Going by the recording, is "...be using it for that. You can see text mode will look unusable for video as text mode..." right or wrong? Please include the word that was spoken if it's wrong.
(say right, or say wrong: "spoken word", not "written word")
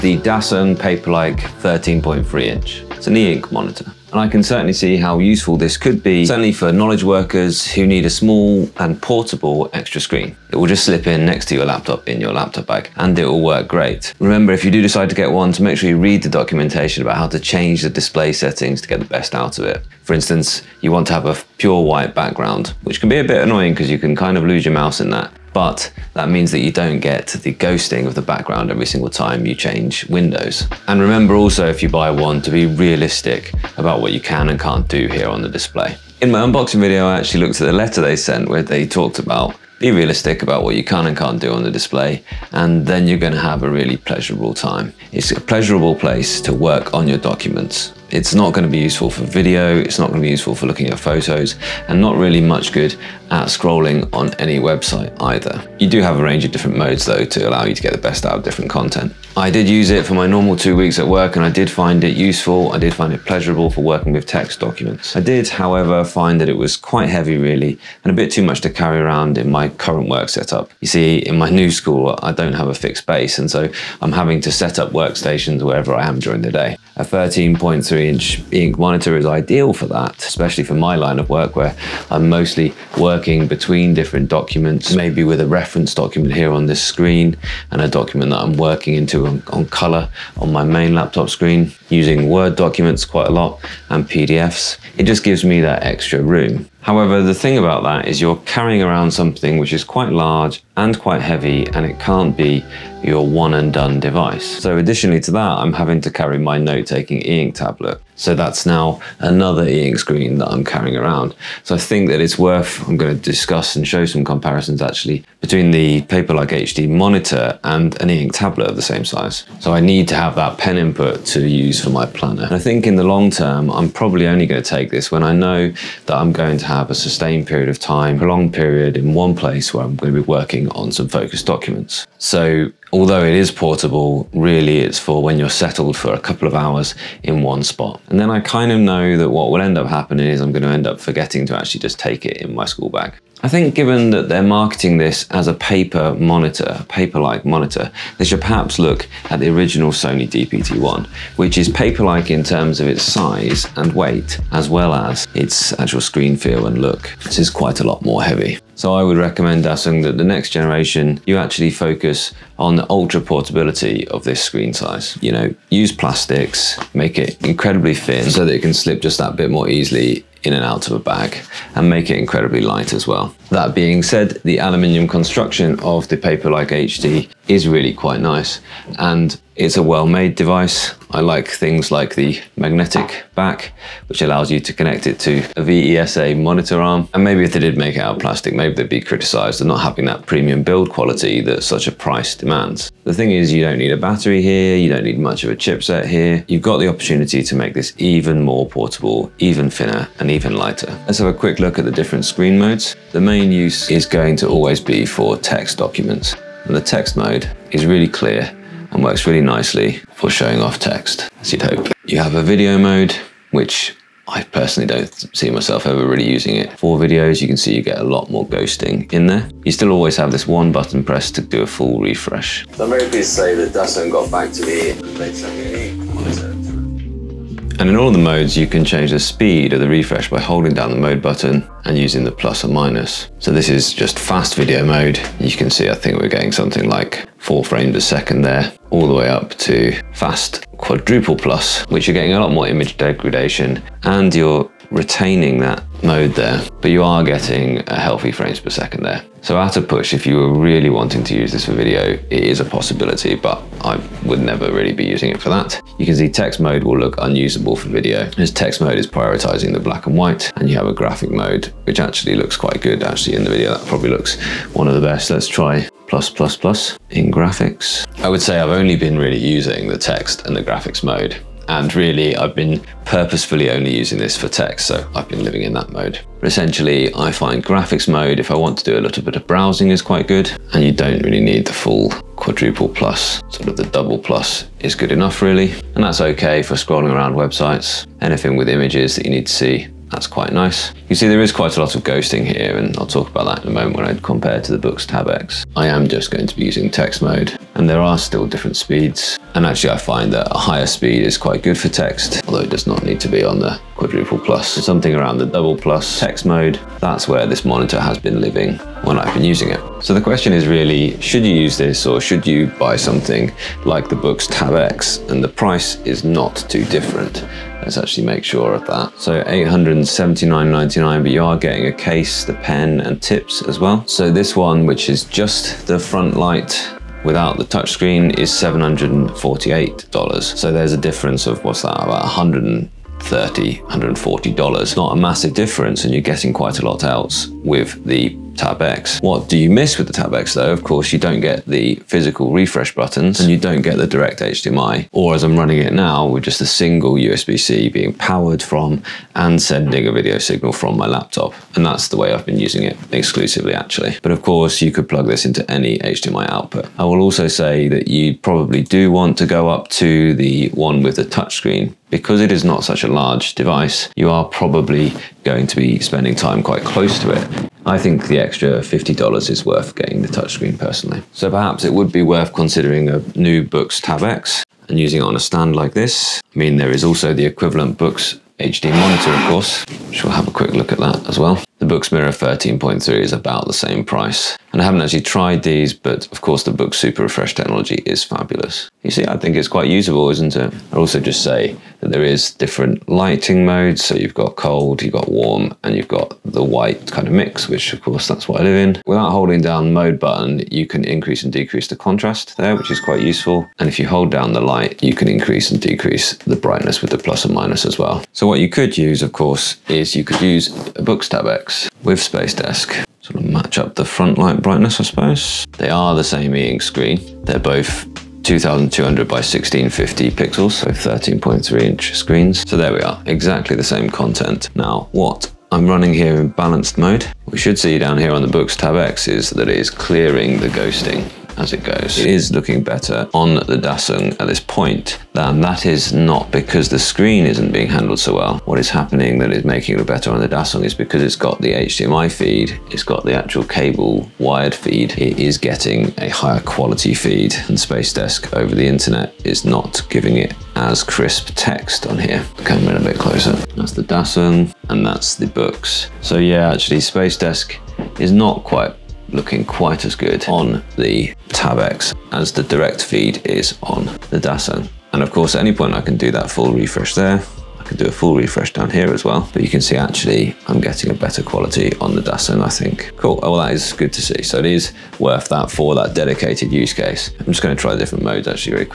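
right.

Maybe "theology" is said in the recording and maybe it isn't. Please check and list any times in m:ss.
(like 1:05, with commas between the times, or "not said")
not said.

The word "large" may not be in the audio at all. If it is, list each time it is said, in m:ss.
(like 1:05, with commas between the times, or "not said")
1:40, 6:03.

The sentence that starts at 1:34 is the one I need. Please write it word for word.
It just gives me that extra room.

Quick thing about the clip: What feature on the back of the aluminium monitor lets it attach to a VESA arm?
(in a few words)
magnetic back.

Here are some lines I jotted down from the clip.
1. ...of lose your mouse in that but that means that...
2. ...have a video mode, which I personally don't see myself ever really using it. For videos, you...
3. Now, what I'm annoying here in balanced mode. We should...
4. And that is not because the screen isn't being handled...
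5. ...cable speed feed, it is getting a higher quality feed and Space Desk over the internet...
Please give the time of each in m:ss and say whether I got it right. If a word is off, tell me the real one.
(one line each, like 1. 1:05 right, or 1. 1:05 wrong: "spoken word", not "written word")
1. 0:24 right
2. 3:32 right
3. 7:04 wrong: "running", not "annoying"
4. 7:15 right
5. 7:23 wrong: "wired", not "speed".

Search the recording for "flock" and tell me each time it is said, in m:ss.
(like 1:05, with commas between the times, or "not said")
not said.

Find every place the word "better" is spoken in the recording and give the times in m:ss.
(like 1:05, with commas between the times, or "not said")
7:12, 7:20, 7:51.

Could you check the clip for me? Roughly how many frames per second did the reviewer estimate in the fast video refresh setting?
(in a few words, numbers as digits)
4.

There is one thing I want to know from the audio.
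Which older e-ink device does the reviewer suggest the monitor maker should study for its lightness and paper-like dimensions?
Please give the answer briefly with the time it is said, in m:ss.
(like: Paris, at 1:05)
Sony DPT-1, at 2:29.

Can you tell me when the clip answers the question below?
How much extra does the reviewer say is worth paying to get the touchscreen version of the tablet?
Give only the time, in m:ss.
6:08.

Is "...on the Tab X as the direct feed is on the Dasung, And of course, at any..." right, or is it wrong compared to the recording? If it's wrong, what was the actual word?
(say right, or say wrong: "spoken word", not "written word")
right.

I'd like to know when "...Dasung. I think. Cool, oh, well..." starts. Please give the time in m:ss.
7:52.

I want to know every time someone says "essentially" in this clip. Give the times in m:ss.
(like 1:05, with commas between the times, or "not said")
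4:36.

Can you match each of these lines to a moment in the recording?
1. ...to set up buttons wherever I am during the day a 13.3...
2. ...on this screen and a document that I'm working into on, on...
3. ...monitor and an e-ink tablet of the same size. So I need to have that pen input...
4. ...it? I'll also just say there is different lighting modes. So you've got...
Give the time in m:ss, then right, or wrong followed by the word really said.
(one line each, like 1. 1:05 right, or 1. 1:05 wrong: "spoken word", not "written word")
1. 1:14 wrong: "workstations", not "buttons"
2. 1:26 right
3. 1:56 right
4. 6:30 right.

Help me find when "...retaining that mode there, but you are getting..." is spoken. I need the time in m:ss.
4:04.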